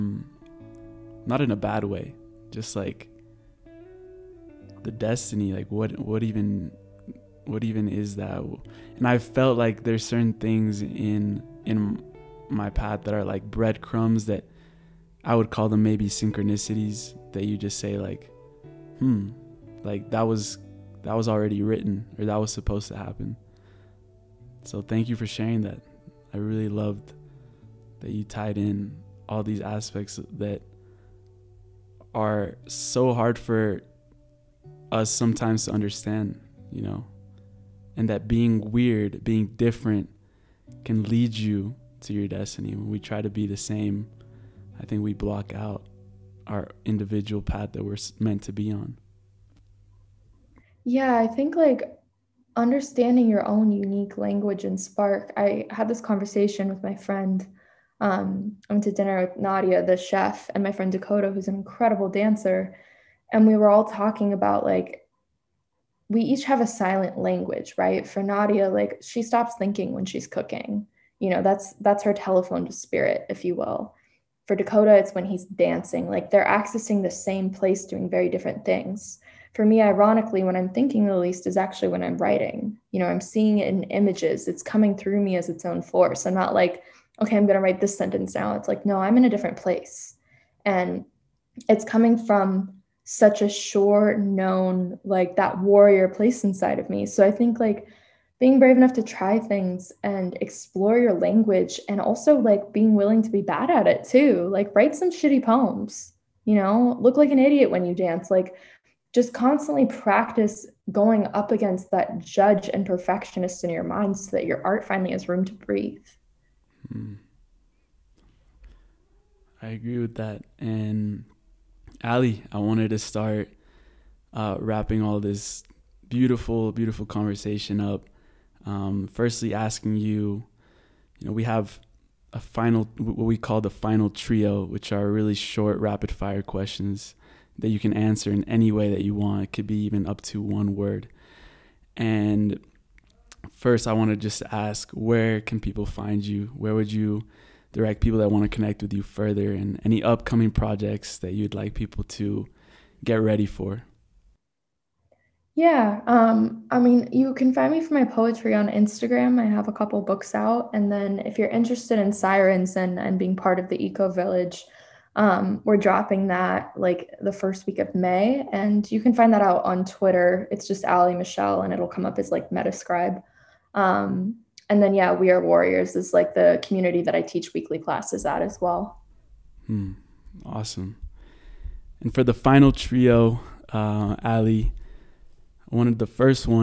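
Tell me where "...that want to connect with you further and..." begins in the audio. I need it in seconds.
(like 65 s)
148 s.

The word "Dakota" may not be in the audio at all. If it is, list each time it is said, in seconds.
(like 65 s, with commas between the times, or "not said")
60 s, 74 s.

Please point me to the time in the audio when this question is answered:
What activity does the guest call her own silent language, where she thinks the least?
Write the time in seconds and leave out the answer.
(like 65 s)
82 s.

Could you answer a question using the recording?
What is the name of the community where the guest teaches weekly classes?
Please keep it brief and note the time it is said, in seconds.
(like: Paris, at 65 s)
We Are Warriors, at 175 s.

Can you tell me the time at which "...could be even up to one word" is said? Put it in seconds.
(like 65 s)
139 s.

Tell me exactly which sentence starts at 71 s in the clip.
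You know, that's that's her telephone to spirit, if you will.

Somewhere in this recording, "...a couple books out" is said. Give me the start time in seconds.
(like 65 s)
159 s.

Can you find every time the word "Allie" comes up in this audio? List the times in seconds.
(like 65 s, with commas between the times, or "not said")
122 s, 170 s.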